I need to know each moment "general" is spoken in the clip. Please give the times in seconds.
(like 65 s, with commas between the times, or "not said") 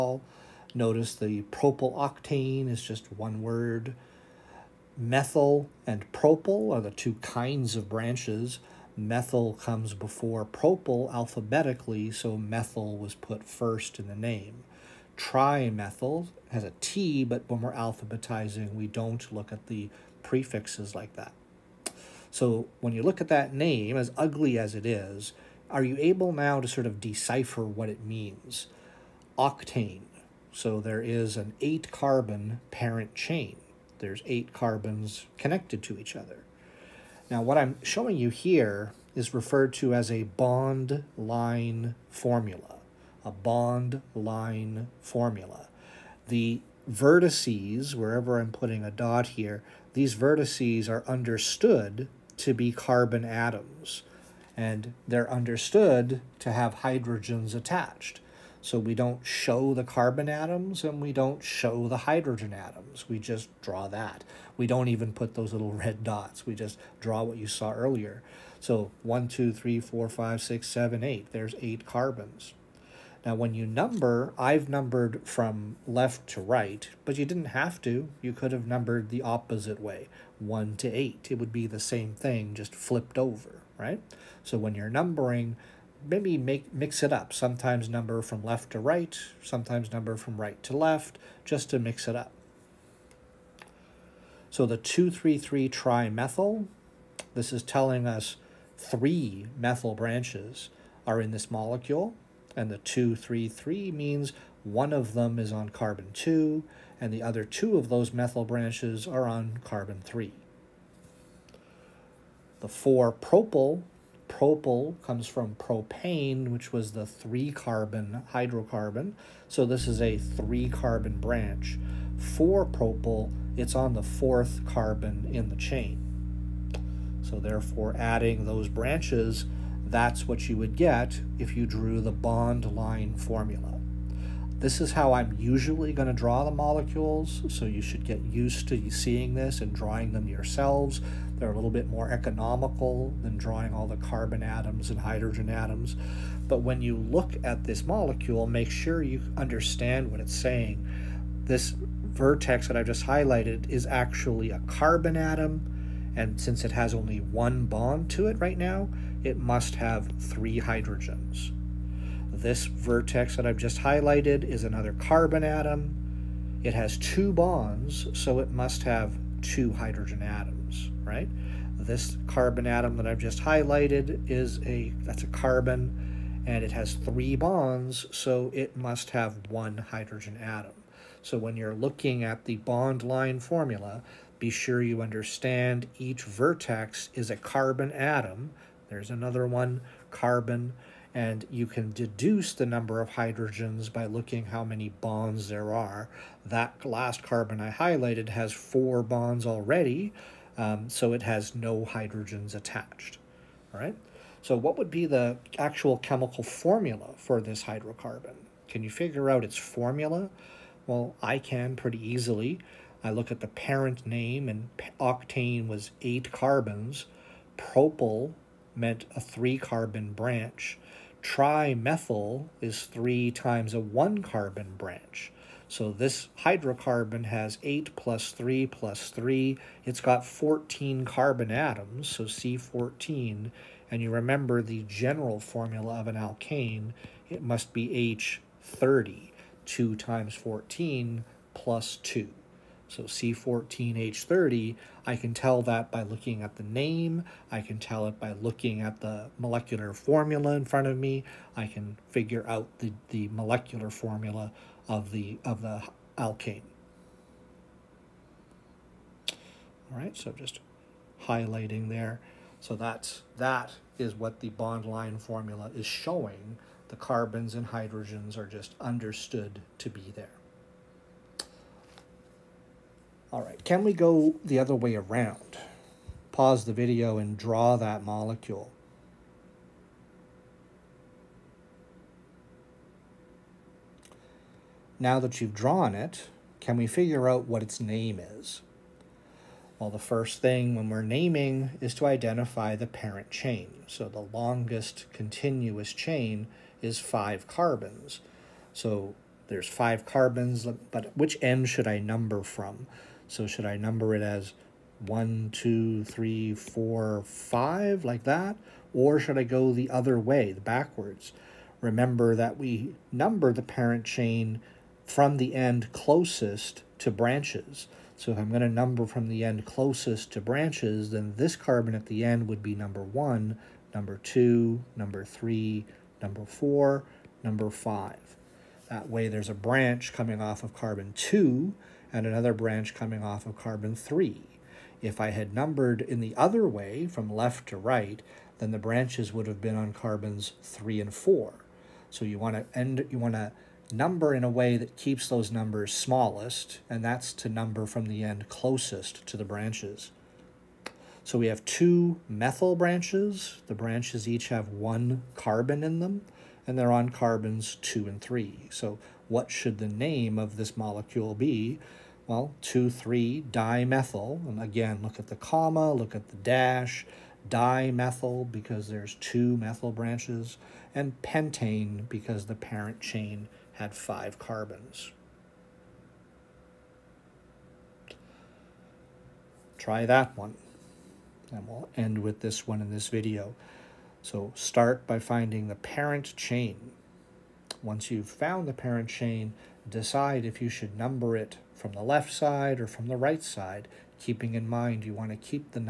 234 s.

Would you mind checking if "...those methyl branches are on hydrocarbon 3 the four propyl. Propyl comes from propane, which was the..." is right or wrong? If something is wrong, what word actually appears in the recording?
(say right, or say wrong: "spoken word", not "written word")
wrong: "carbon", not "hydrocarbon".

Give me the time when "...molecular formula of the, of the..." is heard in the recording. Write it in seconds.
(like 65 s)
253 s.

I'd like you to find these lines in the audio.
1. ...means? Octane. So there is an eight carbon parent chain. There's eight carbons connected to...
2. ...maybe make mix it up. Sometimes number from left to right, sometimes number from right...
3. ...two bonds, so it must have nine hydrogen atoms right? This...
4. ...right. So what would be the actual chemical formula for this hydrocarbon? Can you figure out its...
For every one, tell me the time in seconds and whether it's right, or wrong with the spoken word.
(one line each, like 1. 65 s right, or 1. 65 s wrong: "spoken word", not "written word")
1. 28 s right
2. 86 s right
3. 166 s wrong: "two", not "nine"
4. 203 s right.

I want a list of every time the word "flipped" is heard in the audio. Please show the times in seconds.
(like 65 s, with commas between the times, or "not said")
82 s.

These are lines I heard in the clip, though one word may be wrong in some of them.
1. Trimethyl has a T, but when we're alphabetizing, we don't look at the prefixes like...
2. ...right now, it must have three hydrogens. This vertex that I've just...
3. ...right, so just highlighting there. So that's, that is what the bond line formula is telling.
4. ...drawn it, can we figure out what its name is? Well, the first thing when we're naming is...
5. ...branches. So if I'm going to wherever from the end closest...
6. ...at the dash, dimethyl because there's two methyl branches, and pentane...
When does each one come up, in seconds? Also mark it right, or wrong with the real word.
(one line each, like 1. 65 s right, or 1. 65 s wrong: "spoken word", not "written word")
1. 15 s right
2. 158 s right
3. 259 s wrong: "showing", not "telling"
4. 285 s right
5. 317 s wrong: "number", not "wherever"
6. 366 s right.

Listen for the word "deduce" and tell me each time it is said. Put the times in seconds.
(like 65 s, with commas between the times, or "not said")
191 s.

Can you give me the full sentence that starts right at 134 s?
This is how I'm usually going to draw the molecules, so you should get used to seeing this and drawing them yourselves.